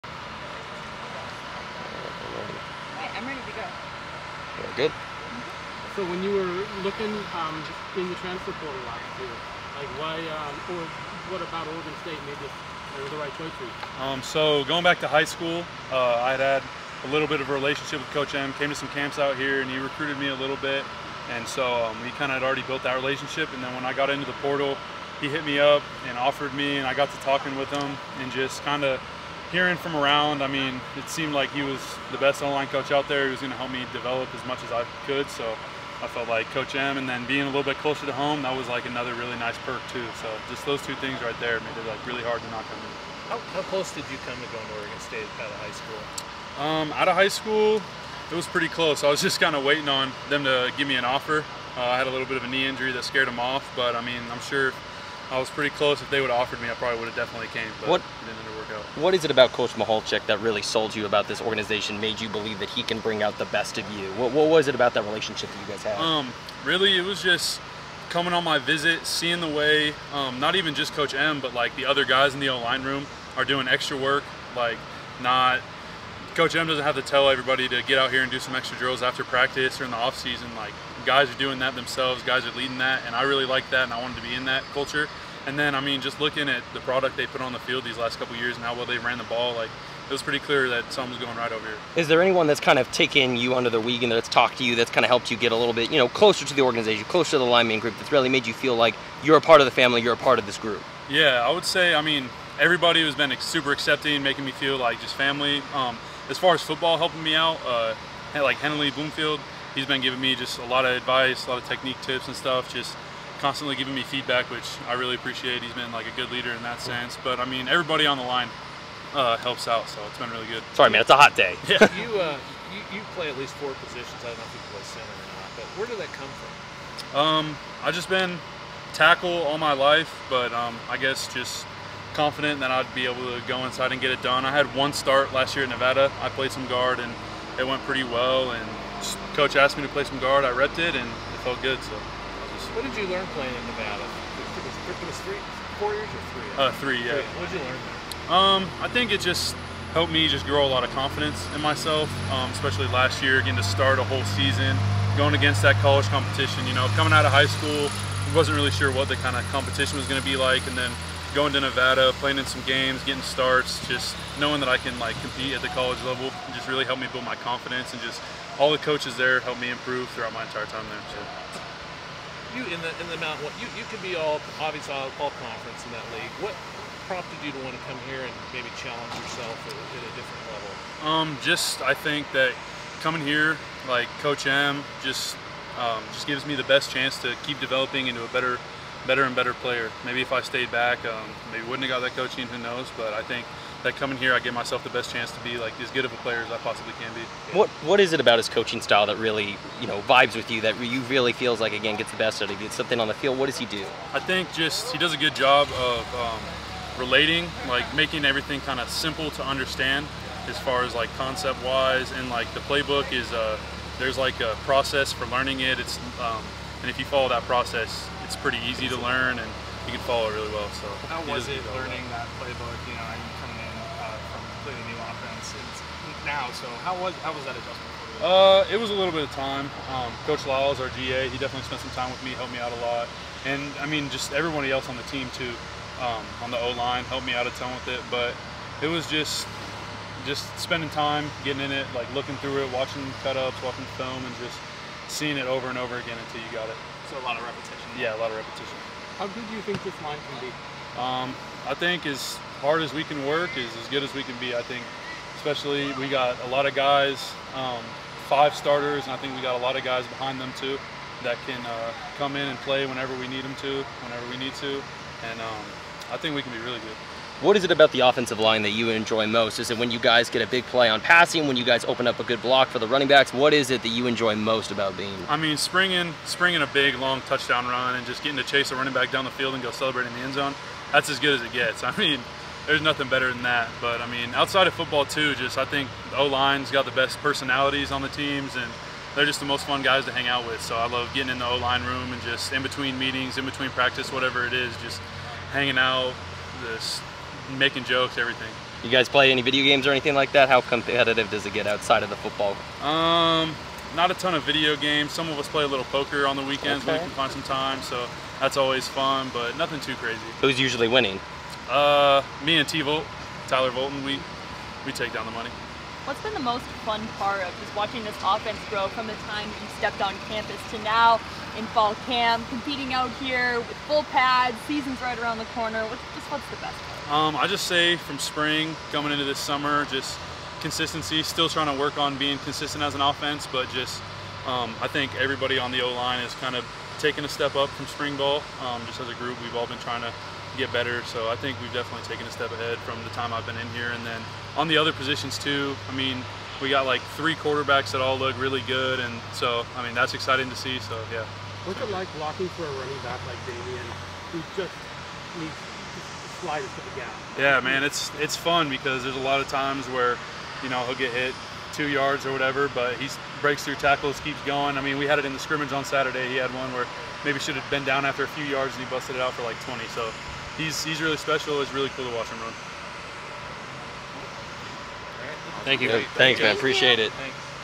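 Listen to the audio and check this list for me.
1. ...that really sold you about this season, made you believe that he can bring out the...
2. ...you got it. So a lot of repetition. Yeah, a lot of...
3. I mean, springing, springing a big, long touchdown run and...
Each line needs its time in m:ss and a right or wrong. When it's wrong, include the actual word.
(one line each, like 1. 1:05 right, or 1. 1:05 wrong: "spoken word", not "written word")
1. 1:00 wrong: "organization", not "season"
2. 4:06 right
3. 4:35 right.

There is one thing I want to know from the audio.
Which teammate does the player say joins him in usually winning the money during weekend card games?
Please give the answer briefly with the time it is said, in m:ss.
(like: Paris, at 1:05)
Tyler Volton, at 5:13.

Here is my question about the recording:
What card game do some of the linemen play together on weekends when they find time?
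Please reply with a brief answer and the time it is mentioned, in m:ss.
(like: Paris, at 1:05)
Poker, at 5:05.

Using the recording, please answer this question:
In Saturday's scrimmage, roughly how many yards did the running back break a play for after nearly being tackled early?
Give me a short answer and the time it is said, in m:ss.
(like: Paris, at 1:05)
20, at 6:09.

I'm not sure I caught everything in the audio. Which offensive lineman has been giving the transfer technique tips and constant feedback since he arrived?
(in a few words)
Henley Bloomfield.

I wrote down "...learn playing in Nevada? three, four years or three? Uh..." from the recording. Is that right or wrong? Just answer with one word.
right.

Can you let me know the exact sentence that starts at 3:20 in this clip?
That you really feels like again gets the best out of you.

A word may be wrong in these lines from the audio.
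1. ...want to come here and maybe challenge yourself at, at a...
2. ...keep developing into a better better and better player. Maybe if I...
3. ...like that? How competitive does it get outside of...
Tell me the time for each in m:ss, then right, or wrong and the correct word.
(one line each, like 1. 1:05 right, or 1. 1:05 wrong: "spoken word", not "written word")
1. 2:57 right
2. 3:07 right
3. 5:00 right.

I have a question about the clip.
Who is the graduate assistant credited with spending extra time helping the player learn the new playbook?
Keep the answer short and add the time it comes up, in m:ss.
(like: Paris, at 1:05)
Coach Lyles, at 3:50.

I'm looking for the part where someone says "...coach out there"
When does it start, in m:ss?
0:32.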